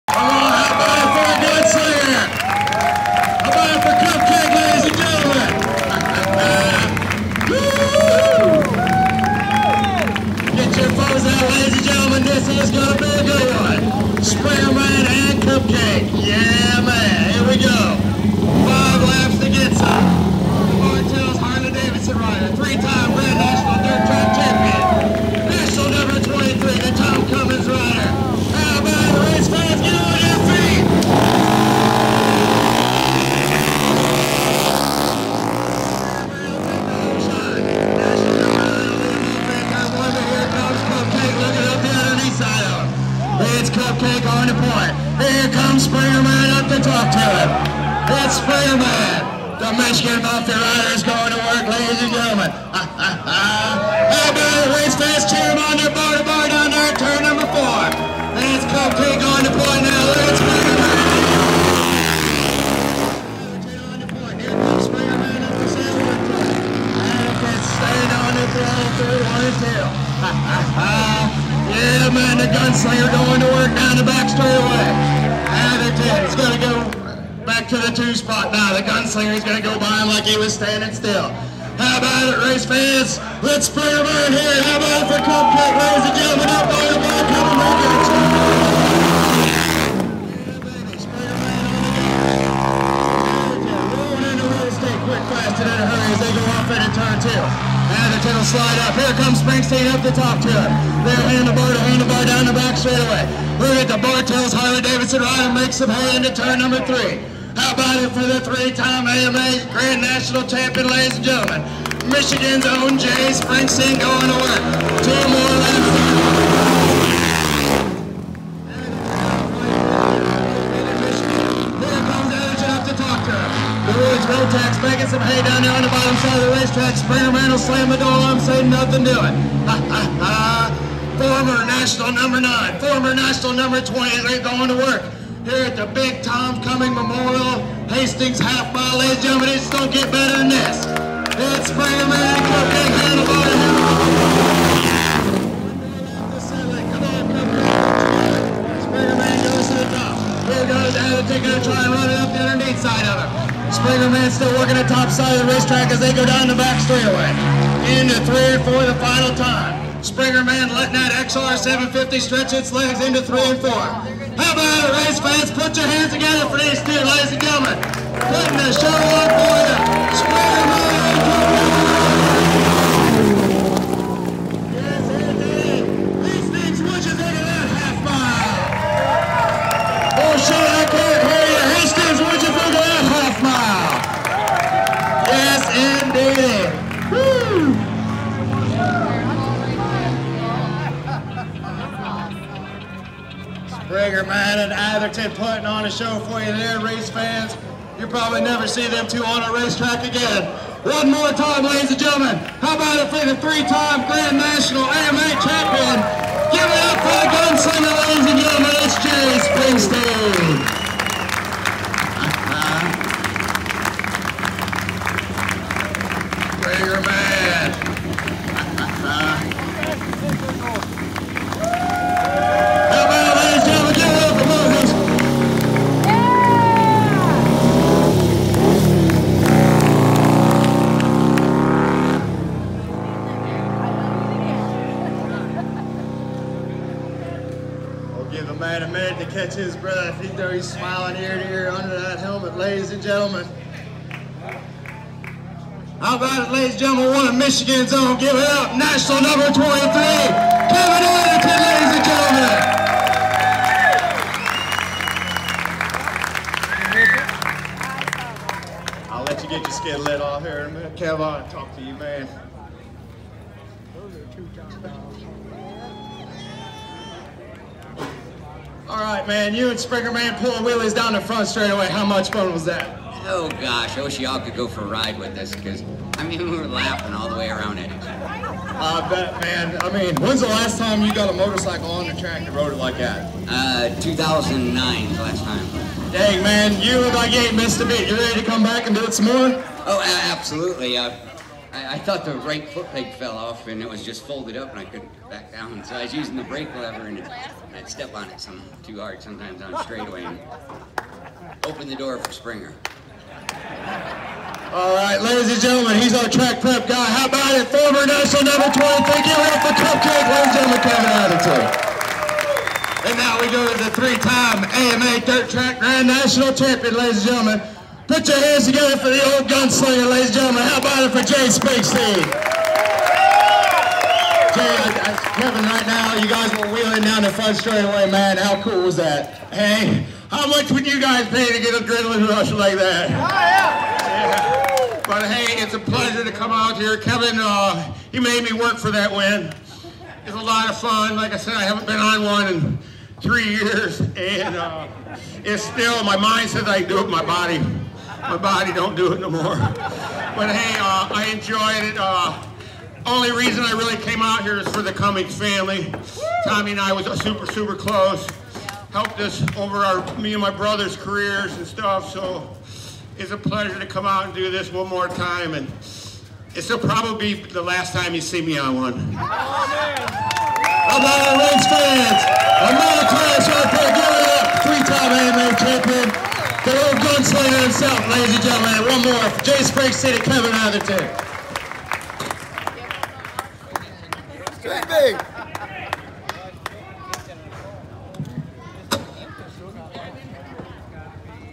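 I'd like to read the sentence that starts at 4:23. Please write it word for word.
Those are two top All right, man, you and Springer Man pulling wheelies down the front straightaway.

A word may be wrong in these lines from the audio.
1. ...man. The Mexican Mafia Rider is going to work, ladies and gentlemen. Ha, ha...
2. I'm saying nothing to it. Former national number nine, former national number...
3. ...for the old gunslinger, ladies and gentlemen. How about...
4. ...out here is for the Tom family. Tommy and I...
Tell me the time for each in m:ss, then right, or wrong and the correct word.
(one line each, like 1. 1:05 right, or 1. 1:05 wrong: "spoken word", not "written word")
1. 0:48 right
2. 2:08 right
3. 5:18 right
4. 5:54 wrong: "Cummings", not "Tom".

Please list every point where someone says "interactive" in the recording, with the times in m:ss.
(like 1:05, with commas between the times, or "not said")
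not said.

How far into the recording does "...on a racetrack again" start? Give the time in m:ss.
3:19.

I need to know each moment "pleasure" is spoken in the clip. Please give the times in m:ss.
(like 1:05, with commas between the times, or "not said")
5:35, 6:03.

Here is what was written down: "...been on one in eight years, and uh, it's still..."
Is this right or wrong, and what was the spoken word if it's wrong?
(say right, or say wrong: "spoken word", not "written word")
wrong: "three", not "eight".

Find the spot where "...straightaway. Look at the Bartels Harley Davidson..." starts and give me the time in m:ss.
1:42.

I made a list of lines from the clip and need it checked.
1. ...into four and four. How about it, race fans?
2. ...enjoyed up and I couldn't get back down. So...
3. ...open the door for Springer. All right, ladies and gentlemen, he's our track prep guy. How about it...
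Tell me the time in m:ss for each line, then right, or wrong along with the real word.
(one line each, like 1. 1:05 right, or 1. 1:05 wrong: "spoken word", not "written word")
1. 2:43 wrong: "three", not "four"
2. 4:54 wrong: "folded", not "enjoyed"
3. 5:01 right.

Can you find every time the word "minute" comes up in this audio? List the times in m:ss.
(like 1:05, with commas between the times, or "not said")
3:58, 4:20.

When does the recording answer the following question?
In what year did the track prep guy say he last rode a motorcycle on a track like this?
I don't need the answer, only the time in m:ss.
4:44.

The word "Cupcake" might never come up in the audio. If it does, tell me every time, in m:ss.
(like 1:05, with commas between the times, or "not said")
1:25, 5:09.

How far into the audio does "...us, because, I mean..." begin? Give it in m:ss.
4:35.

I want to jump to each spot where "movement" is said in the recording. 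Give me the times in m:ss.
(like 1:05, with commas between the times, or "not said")
not said.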